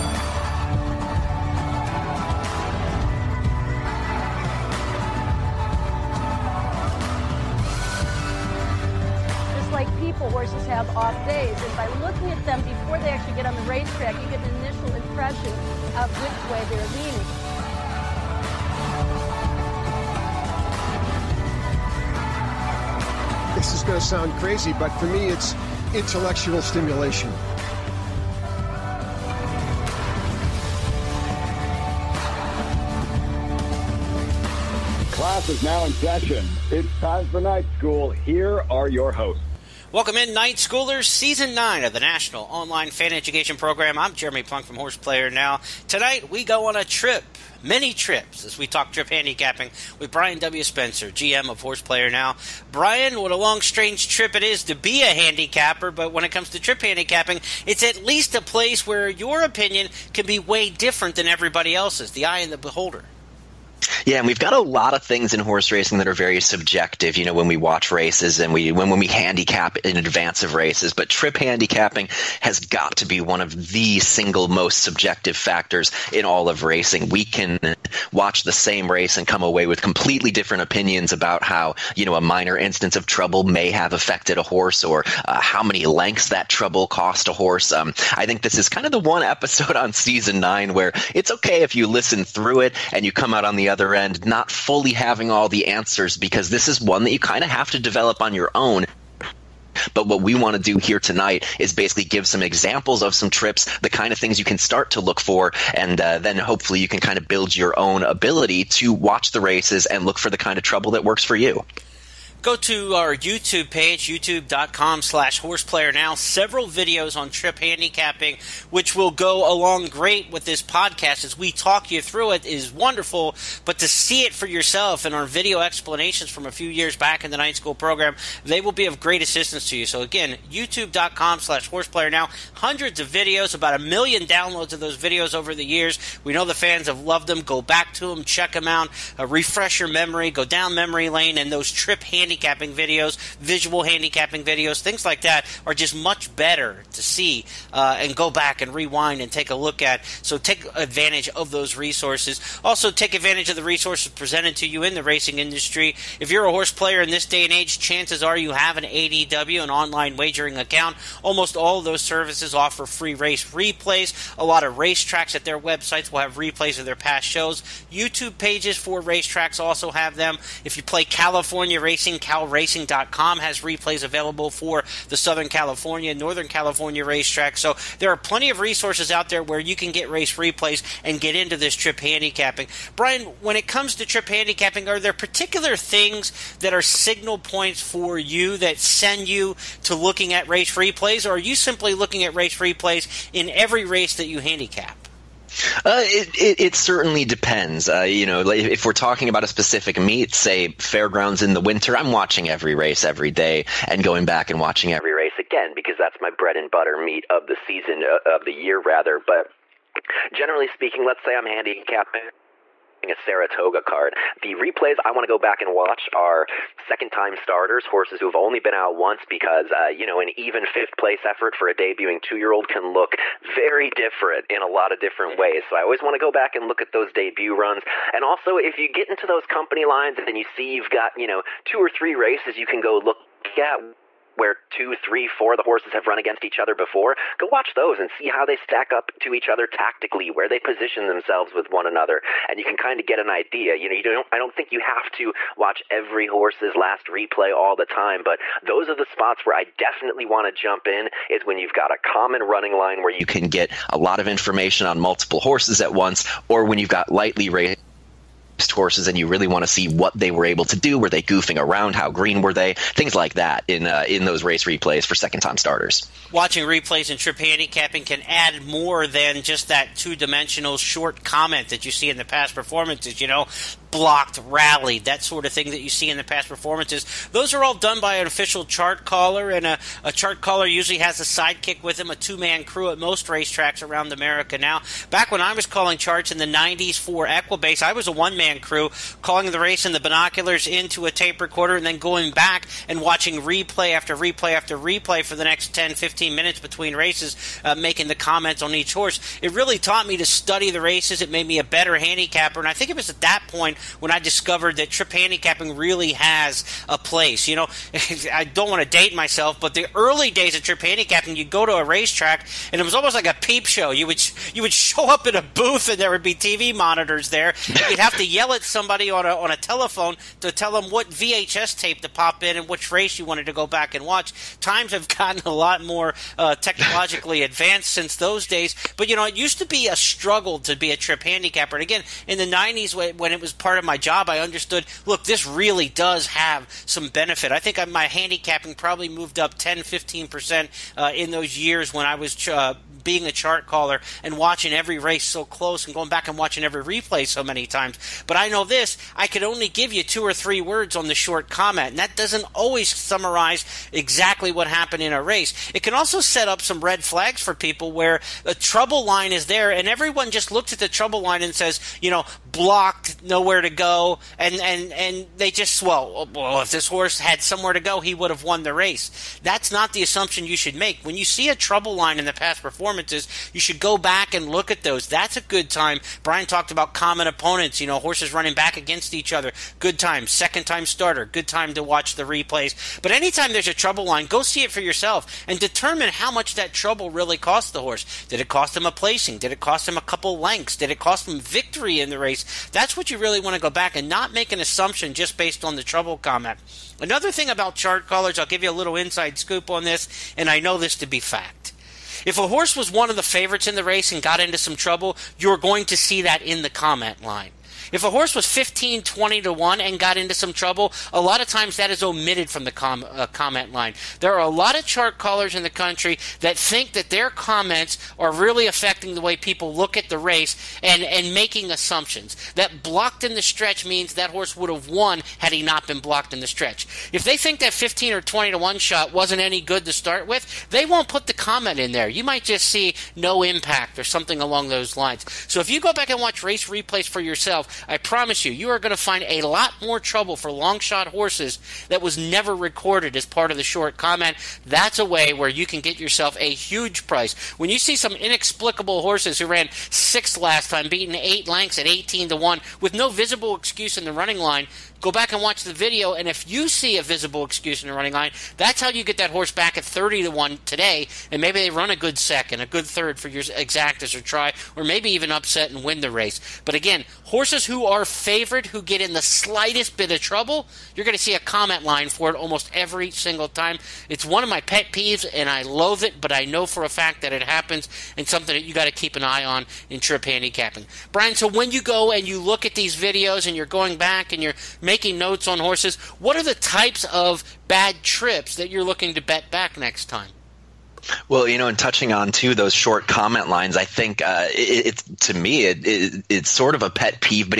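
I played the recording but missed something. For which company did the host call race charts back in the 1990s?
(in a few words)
Equibase.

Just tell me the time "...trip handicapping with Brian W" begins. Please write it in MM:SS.
00:48.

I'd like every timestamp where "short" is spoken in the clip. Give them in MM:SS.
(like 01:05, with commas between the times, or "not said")
04:30, 05:51, 07:23, 08:12.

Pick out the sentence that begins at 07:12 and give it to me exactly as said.
You might just see no impact or something along those lines.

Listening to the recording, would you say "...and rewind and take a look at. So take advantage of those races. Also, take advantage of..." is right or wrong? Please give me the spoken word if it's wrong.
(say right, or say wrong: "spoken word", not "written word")
wrong: "resources", not "races".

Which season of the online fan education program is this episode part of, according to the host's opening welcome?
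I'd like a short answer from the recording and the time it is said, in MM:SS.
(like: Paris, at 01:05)
Season 9, at 00:41.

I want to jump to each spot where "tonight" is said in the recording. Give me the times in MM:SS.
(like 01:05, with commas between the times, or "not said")
00:45, 01:40.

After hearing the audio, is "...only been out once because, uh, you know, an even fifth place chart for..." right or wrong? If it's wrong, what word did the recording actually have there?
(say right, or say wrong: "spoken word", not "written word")
wrong: "effort", not "chart".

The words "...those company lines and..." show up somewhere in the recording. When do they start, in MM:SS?
03:49.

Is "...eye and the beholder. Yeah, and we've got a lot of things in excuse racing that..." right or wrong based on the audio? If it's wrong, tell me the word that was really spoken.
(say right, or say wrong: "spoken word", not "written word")
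wrong: "horse", not "excuse".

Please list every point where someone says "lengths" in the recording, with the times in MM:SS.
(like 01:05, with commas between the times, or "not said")
01:25, 06:30, 07:31.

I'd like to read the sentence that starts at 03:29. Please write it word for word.
But generally speaking, let's say I'm handicapping a Saratoga card.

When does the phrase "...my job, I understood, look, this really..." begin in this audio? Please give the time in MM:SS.
05:33.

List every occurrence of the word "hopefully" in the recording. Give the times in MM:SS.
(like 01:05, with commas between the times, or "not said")
01:46.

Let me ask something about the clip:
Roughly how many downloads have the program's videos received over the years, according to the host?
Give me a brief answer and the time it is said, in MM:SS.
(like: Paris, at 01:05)
about a million, at 02:13.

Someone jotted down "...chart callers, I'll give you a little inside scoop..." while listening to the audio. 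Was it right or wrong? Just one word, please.
right.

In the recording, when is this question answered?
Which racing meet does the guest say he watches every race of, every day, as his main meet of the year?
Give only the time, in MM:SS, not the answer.
03:20.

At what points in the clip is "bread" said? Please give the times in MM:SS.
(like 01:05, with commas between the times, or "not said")
03:26.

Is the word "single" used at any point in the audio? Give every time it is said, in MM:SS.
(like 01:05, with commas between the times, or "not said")
01:13, 07:53.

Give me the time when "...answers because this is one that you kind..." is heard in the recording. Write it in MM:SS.
01:35.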